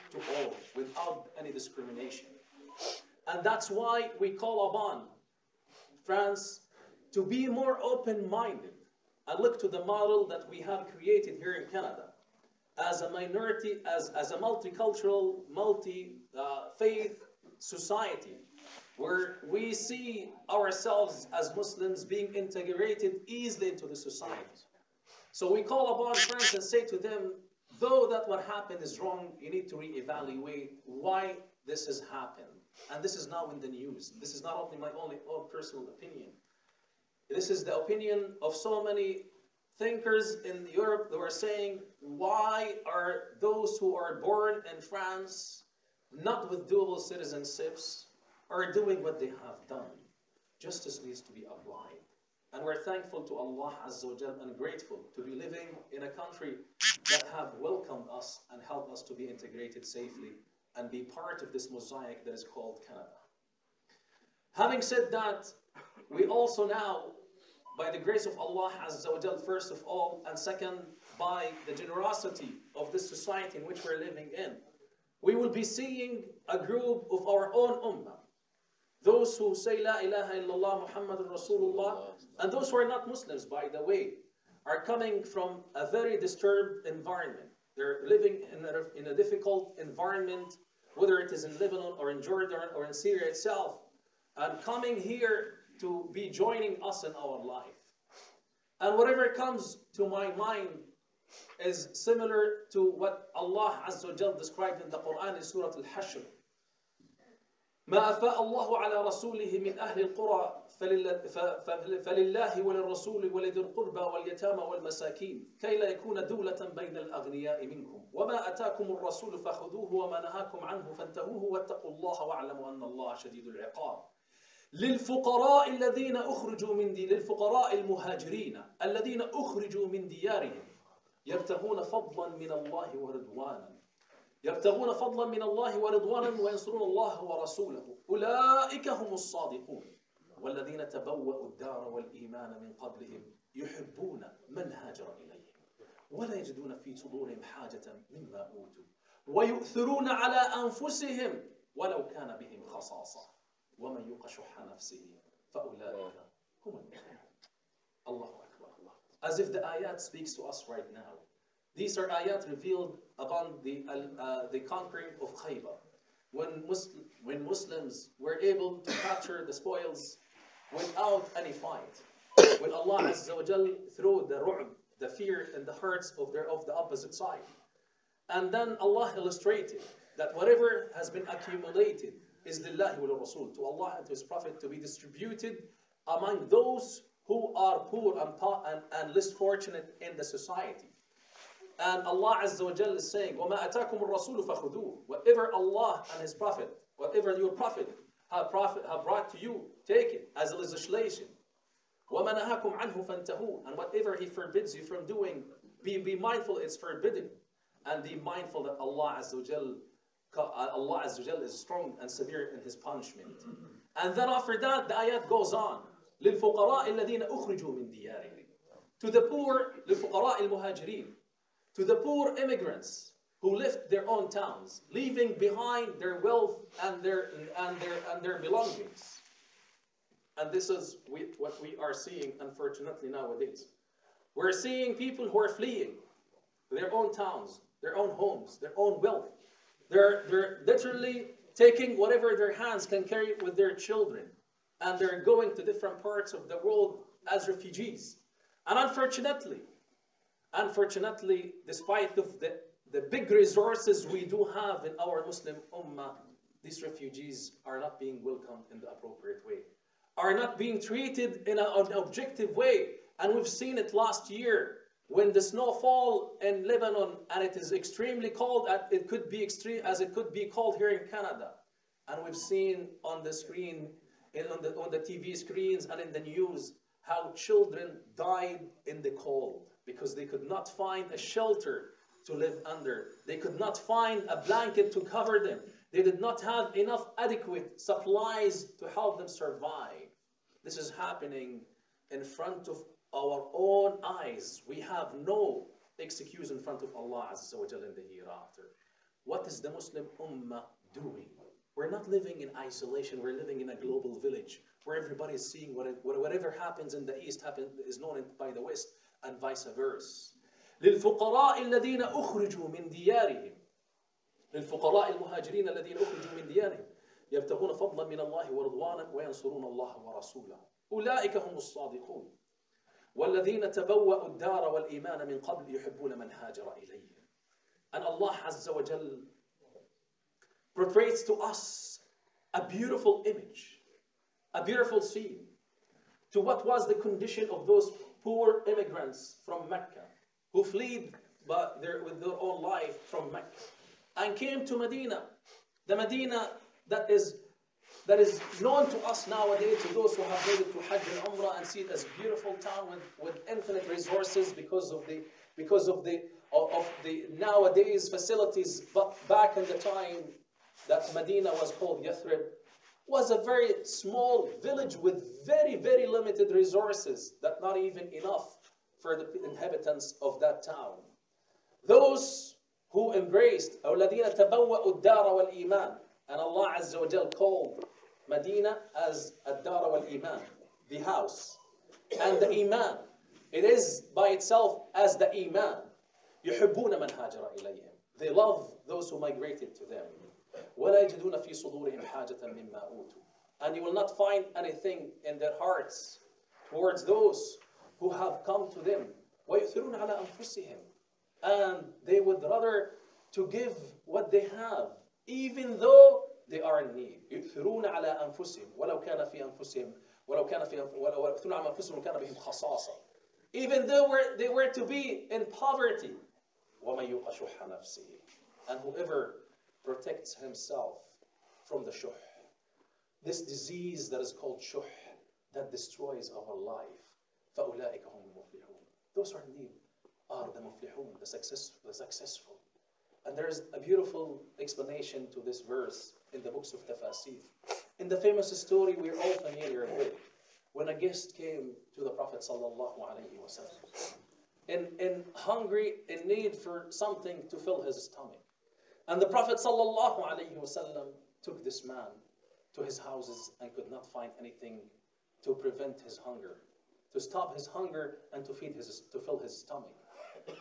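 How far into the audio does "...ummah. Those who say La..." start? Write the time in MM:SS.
01:17.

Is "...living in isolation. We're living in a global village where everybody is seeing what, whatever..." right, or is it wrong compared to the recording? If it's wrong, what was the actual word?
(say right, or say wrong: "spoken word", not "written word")
right.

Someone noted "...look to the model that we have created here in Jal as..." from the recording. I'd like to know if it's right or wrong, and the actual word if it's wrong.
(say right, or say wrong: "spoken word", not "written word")
wrong: "Canada", not "Jal".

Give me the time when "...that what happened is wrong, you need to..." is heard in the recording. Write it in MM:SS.
00:28.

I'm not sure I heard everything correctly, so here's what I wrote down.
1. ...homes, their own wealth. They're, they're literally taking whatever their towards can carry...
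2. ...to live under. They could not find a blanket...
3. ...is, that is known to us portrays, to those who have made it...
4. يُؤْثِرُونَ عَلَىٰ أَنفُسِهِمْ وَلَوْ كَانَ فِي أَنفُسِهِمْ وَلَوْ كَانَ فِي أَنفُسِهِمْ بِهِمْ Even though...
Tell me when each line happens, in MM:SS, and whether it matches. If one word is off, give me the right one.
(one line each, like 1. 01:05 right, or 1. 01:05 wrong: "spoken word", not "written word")
1. 03:58 wrong: "hands", not "towards"
2. 04:42 right
3. 05:47 wrong: "nowadays", not "portrays"
4. 06:47 right.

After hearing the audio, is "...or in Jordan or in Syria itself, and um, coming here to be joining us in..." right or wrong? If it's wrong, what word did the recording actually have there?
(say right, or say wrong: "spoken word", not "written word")
right.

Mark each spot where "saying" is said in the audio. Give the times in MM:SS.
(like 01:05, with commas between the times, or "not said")
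00:41, 03:13.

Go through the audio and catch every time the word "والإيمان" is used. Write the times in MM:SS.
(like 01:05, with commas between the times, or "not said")
02:21, 05:24.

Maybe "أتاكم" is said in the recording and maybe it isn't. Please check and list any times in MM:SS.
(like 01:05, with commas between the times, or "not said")
01:58, 03:13.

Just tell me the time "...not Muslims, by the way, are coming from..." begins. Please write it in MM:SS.
01:22.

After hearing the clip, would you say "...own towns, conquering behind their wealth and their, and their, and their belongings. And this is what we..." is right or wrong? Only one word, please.
wrong.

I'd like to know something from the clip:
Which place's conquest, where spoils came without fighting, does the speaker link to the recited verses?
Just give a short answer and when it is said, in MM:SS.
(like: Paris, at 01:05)
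Khaybar, at 02:45.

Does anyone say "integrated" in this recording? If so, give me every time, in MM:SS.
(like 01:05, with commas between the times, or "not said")
00:22, 00:59.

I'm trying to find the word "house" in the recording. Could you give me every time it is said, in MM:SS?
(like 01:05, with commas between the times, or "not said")
06:20, 07:32.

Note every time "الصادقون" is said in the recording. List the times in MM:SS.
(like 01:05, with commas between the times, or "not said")
02:19, 05:21.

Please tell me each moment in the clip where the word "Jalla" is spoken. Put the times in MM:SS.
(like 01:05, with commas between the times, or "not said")
03:12, 03:29.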